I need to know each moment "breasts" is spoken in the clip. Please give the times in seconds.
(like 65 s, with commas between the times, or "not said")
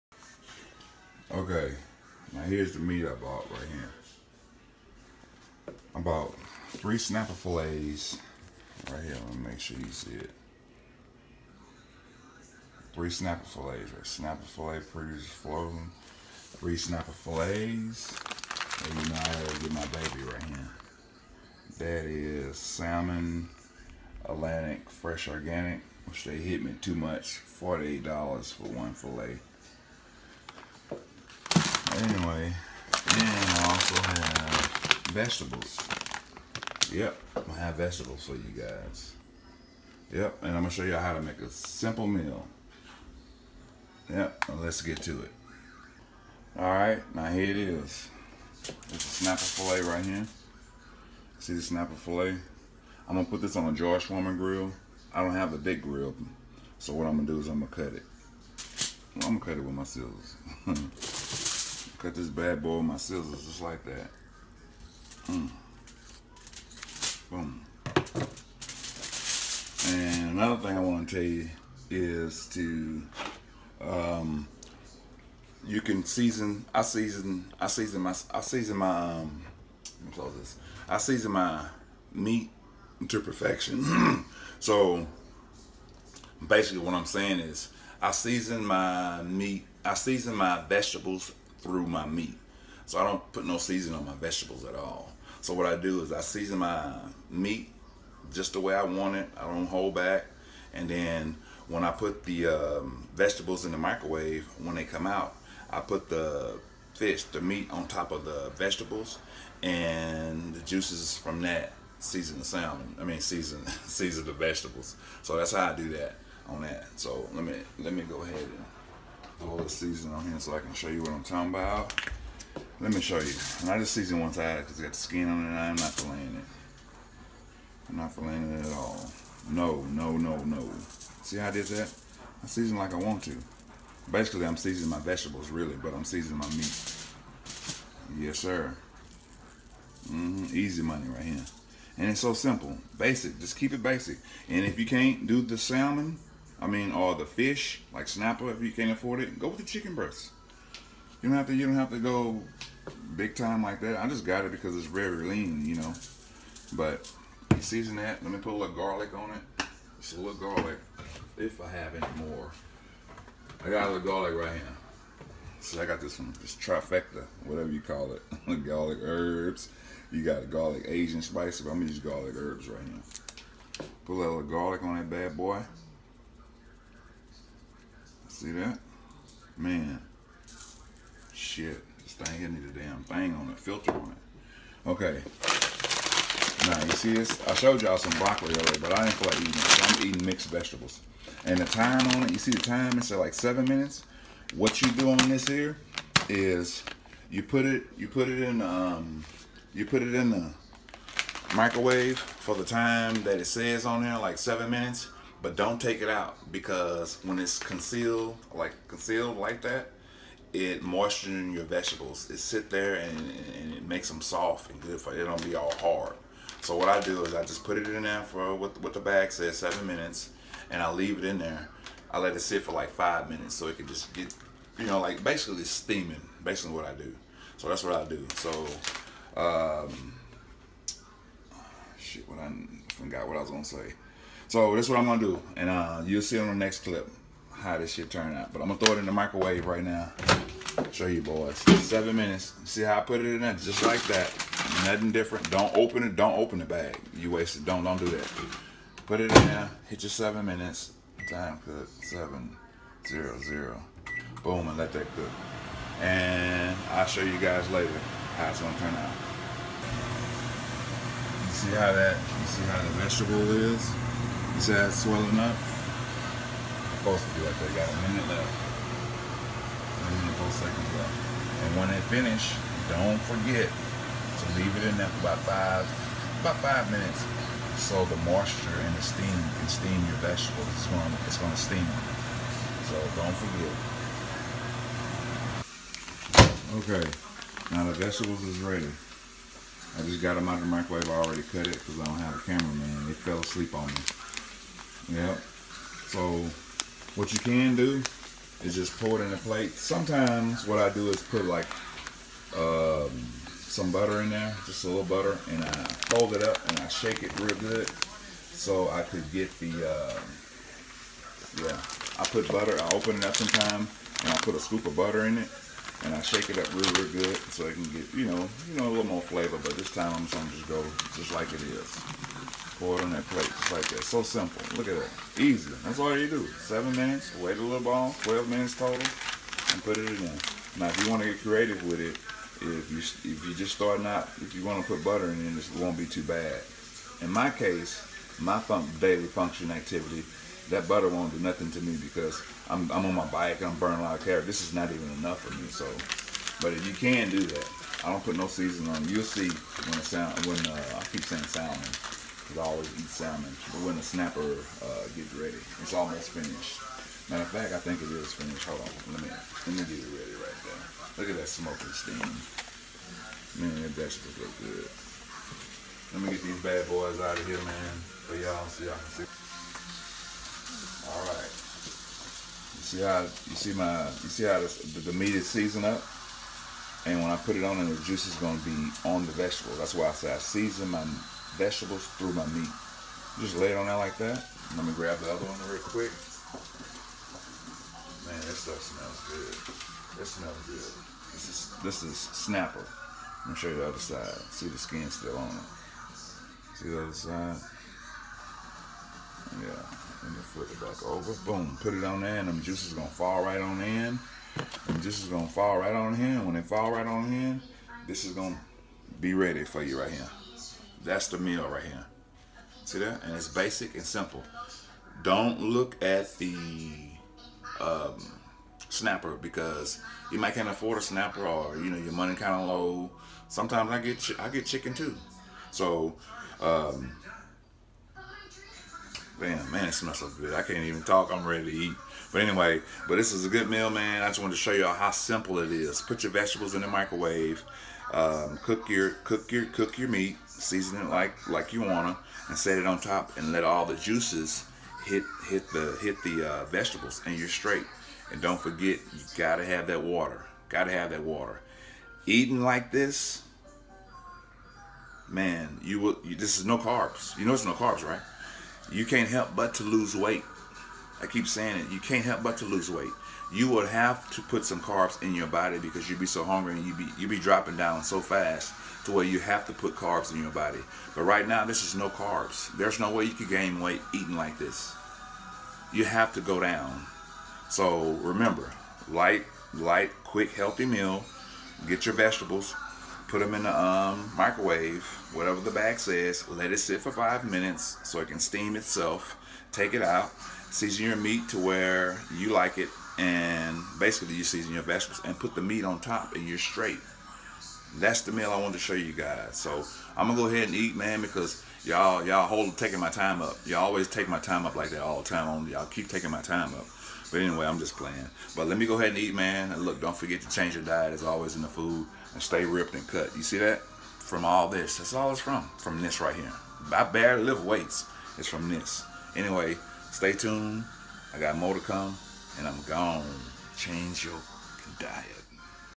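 149 s.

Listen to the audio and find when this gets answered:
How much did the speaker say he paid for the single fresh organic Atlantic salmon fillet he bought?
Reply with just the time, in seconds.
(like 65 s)
27 s.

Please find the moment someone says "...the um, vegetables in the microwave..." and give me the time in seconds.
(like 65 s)
102 s.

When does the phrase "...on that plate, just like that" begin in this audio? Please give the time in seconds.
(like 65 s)
323 s.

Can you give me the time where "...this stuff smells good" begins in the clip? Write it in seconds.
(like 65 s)
388 s.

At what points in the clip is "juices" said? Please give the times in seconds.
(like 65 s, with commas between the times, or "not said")
110 s, 378 s, 402 s, 443 s.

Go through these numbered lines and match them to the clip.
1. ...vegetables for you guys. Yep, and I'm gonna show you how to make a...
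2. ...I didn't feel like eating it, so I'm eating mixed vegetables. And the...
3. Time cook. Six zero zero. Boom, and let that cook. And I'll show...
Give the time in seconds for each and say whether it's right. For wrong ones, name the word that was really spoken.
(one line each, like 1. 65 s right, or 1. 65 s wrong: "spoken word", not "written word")
1. 37 s right
2. 188 s right
3. 251 s wrong: "Seven", not "Six".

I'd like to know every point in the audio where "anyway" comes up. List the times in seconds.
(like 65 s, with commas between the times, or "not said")
31 s, 432 s, 507 s, 519 s.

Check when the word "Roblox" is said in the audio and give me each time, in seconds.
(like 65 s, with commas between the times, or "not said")
not said.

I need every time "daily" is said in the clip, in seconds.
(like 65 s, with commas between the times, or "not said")
338 s.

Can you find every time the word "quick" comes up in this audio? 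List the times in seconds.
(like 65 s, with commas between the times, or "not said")
385 s, 480 s.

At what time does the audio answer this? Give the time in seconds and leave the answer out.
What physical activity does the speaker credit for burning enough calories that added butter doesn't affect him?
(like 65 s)
343 s.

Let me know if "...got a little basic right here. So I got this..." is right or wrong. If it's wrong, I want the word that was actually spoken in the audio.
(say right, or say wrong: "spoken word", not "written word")
wrong: "garlic", not "basic".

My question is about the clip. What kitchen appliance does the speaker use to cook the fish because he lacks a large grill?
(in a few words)
George Foreman grill.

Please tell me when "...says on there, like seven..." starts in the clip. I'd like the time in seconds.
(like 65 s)
203 s.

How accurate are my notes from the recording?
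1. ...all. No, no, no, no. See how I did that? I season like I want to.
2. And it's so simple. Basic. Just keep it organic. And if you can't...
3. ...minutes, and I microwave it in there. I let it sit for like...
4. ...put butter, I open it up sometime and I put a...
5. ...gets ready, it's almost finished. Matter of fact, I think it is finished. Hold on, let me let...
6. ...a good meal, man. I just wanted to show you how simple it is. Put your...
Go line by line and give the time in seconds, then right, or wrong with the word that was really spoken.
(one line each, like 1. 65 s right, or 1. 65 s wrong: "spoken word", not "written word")
1. 128 s right
2. 141 s wrong: "basic", not "organic"
3. 219 s wrong: "leave", not "microwave"
4. 312 s right
5. 355 s right
6. 433 s right.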